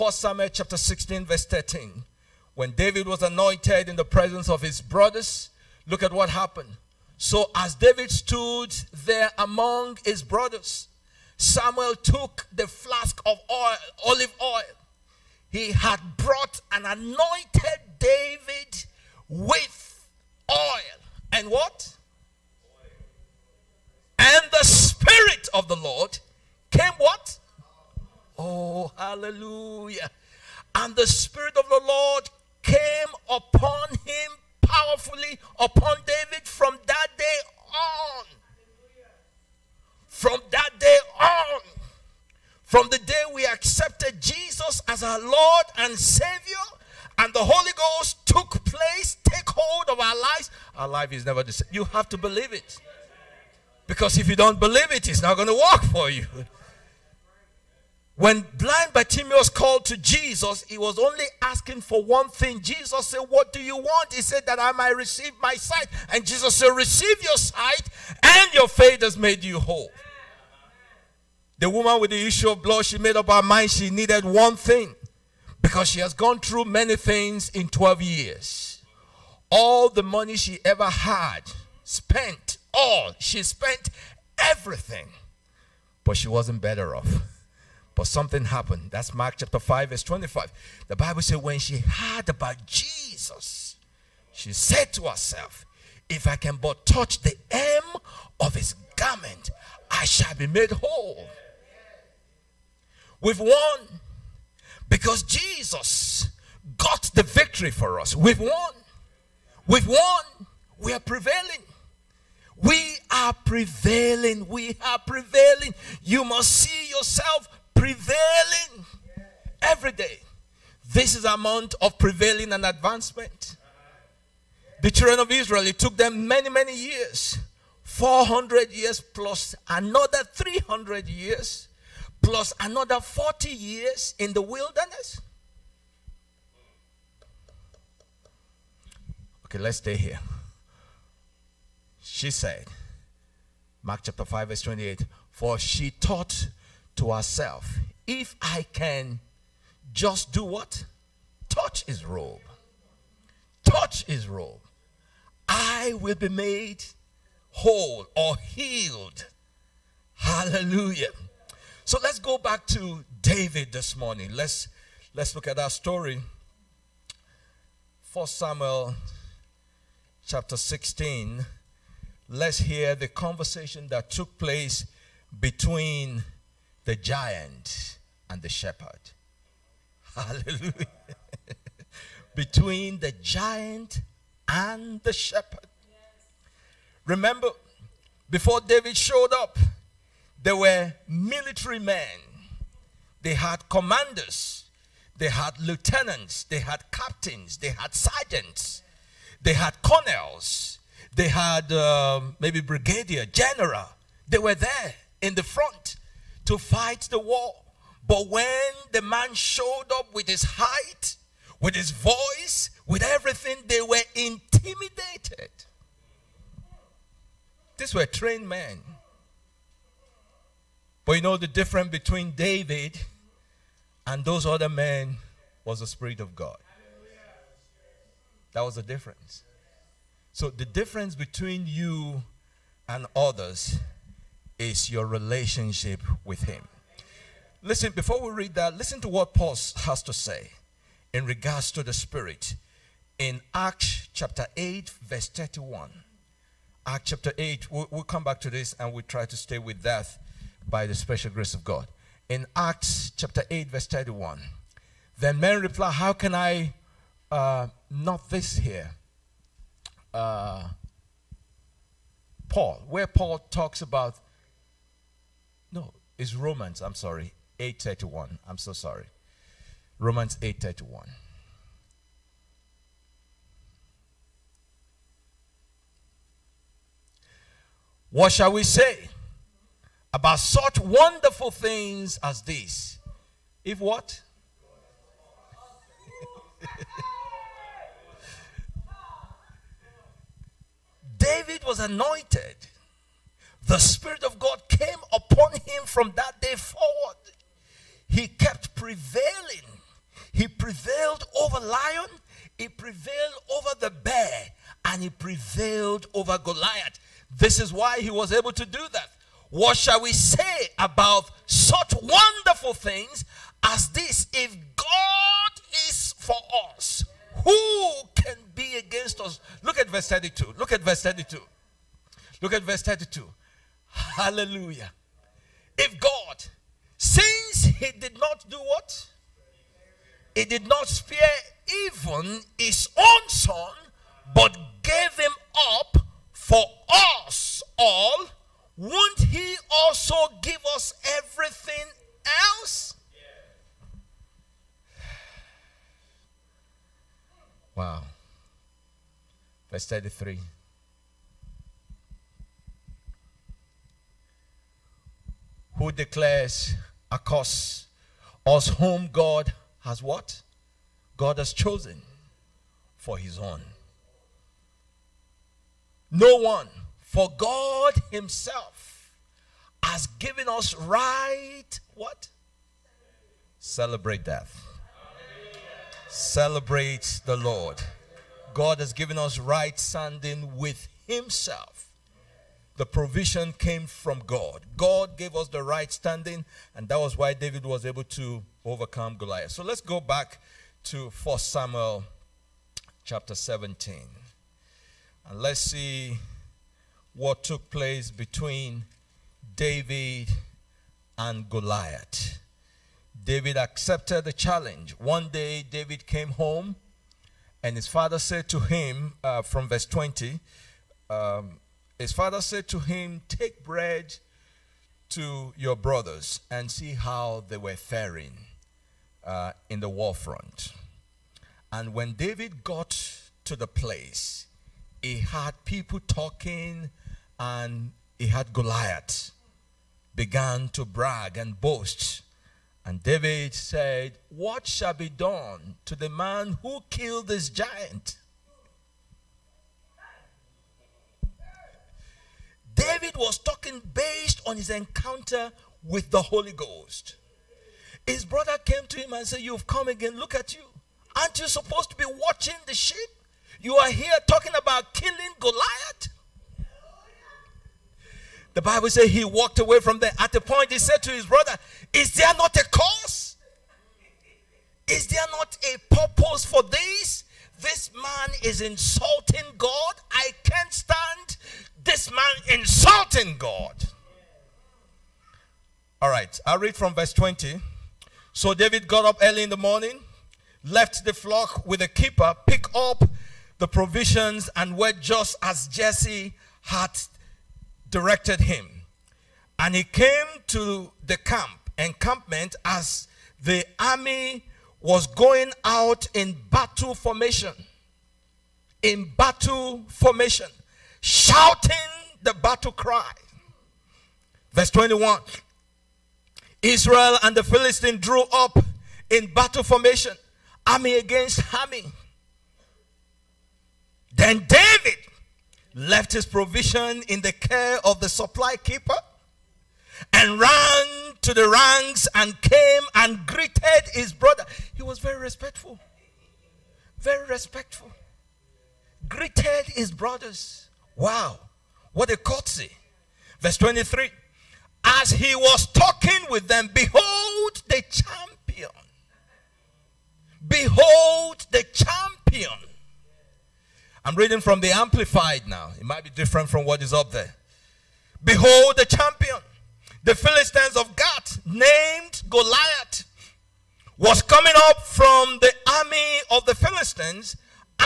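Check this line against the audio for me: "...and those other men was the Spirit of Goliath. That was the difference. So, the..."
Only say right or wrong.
wrong.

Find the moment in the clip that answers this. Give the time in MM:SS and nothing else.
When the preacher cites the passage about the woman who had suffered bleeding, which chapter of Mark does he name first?
01:29.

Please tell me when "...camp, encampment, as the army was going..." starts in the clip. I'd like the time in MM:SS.
08:11.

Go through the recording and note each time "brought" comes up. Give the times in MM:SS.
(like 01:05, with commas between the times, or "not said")
00:16.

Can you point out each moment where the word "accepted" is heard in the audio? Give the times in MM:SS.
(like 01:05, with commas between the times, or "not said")
00:43, 06:43.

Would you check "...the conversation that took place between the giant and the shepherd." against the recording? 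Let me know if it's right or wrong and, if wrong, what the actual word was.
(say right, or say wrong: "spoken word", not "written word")
right.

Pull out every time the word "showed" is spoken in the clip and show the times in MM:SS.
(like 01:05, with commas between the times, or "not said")
03:08, 03:29.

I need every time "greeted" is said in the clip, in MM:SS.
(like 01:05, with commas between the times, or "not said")
08:43, 08:49.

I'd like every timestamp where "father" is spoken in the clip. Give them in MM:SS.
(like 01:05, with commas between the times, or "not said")
06:47, 06:52.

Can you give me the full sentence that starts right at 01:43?
With one because Jesus got the victory for us.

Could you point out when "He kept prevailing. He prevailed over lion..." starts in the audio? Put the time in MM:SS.
04:58.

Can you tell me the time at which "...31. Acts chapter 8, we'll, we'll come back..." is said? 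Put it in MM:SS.
04:05.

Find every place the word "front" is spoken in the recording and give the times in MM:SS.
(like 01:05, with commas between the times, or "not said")
03:25, 07:00.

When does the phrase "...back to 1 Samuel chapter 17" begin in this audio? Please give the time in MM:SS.
06:29.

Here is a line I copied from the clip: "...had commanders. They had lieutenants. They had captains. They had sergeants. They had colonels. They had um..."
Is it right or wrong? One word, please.
right.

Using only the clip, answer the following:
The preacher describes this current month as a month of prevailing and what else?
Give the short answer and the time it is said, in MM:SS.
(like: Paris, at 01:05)
advancement, at 02:02.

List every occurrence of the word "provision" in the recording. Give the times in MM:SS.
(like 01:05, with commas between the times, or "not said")
06:22, 08:03, 08:36.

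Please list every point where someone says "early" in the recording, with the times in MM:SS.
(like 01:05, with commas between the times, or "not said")
07:59.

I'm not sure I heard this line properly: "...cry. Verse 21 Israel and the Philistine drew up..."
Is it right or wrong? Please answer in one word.
right.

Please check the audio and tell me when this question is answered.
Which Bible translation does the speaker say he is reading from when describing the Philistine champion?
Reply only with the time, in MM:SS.
09:04.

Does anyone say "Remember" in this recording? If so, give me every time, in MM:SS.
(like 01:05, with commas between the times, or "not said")
03:07.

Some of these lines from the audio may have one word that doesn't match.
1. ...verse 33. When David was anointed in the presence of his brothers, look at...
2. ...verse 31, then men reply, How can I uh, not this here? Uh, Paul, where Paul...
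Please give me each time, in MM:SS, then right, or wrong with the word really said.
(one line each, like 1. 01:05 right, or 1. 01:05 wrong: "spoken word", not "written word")
1. 00:01 wrong: "13", not "33"
2. 04:13 right.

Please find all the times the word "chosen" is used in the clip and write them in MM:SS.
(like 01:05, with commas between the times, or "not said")
06:01.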